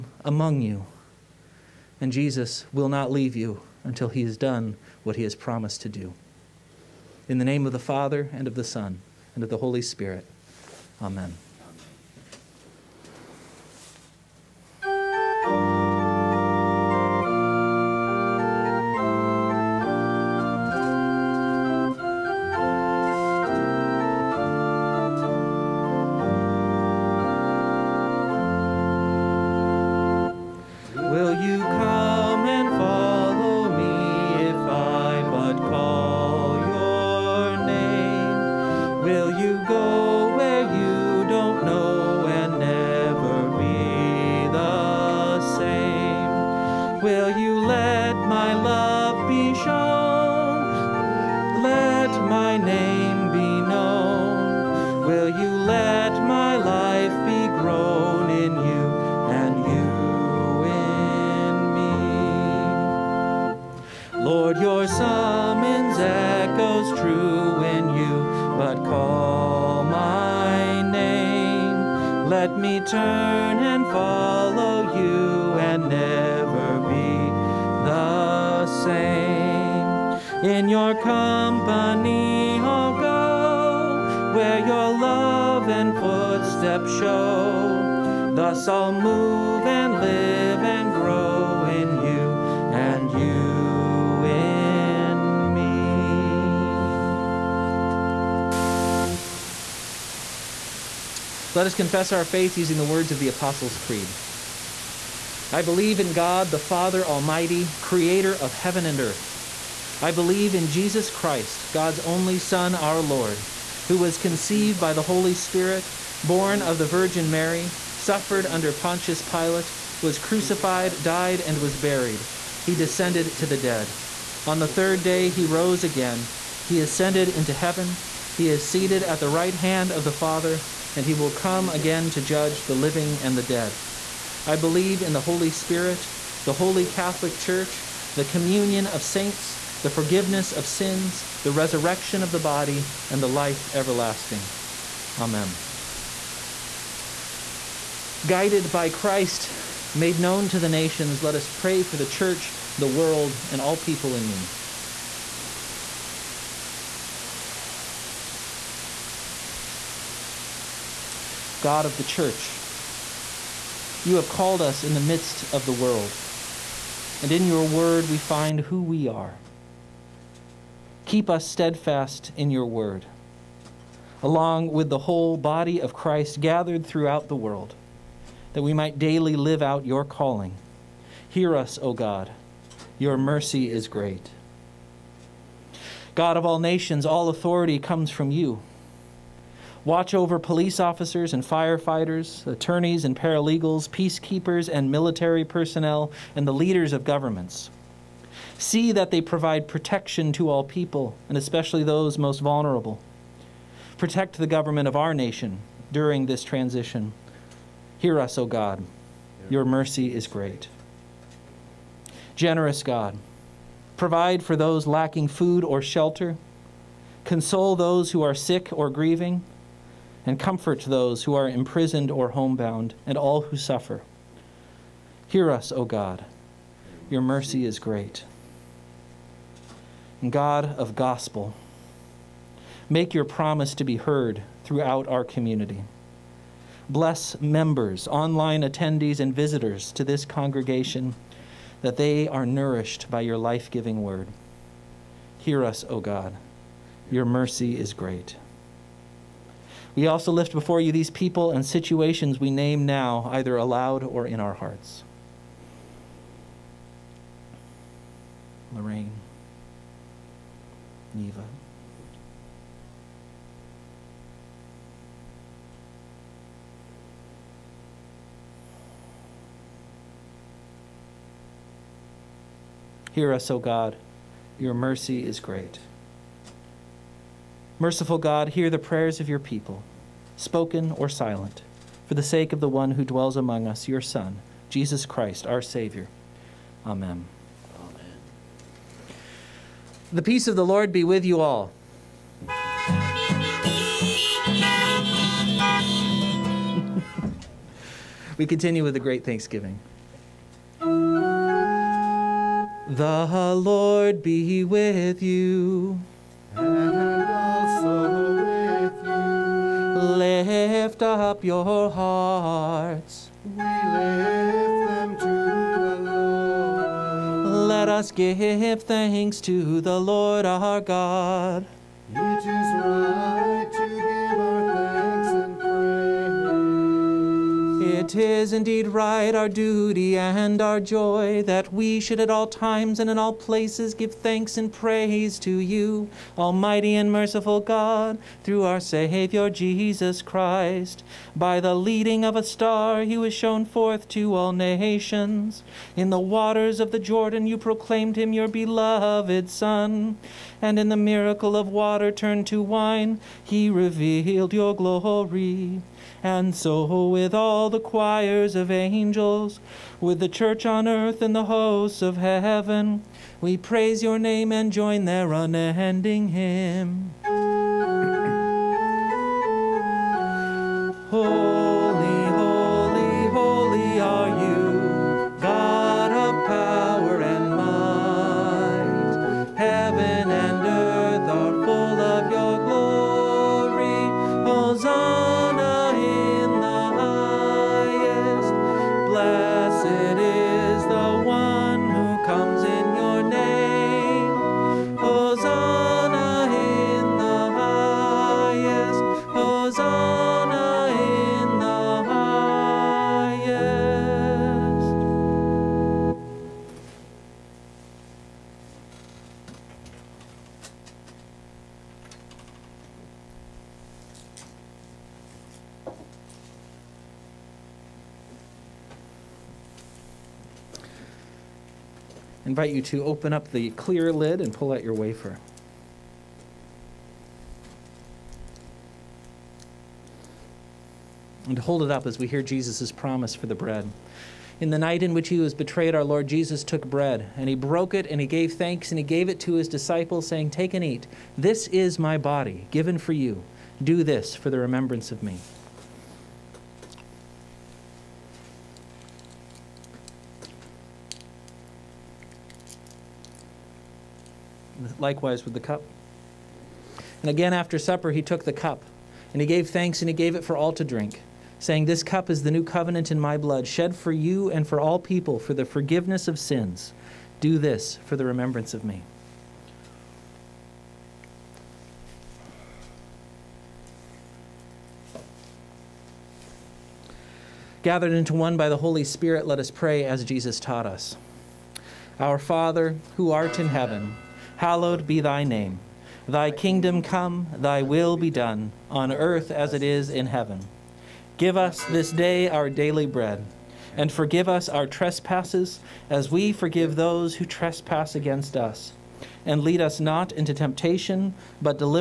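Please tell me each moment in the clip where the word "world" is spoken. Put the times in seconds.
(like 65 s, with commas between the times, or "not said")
152 s, 165 s, 177 s.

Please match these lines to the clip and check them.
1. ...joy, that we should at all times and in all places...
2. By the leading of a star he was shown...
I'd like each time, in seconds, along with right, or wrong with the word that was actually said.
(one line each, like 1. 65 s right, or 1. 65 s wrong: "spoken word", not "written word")
1. 330 s right
2. 341 s right.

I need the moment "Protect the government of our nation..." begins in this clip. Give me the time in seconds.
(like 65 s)
203 s.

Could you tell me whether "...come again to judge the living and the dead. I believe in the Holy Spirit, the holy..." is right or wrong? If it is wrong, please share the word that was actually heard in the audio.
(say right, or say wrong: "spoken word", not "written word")
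right.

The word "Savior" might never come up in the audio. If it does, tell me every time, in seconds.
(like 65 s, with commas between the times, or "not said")
285 s, 338 s.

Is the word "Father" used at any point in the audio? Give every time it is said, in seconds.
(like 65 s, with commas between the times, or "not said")
7 s, 106 s, 130 s, 482 s.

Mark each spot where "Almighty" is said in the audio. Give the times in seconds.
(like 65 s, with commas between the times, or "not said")
107 s, 336 s.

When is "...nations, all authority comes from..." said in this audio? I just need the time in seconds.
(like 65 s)
186 s.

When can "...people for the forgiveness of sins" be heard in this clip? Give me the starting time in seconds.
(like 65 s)
464 s.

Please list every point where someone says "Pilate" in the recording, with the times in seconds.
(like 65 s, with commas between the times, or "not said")
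119 s.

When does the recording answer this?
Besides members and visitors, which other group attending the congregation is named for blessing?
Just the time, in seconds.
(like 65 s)
238 s.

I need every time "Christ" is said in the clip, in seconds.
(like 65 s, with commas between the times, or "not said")
111 s, 148 s, 175 s, 285 s, 340 s.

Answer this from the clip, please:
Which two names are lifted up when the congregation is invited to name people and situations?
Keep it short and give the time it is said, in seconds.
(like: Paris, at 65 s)
Lorraine, Neva, at 258 s.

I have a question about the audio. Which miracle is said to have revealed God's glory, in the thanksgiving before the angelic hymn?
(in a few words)
Water turned to wine.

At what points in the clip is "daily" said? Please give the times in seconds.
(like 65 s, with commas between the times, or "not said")
178 s, 492 s.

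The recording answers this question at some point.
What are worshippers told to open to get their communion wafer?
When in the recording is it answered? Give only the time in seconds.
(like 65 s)
423 s.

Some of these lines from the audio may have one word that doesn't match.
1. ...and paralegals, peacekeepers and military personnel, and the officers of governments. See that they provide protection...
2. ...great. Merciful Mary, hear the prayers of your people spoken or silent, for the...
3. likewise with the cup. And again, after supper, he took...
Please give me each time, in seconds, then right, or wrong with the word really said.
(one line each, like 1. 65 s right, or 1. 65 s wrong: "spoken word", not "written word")
1. 193 s wrong: "leaders", not "officers"
2. 275 s wrong: "God", not "Mary"
3. 455 s right.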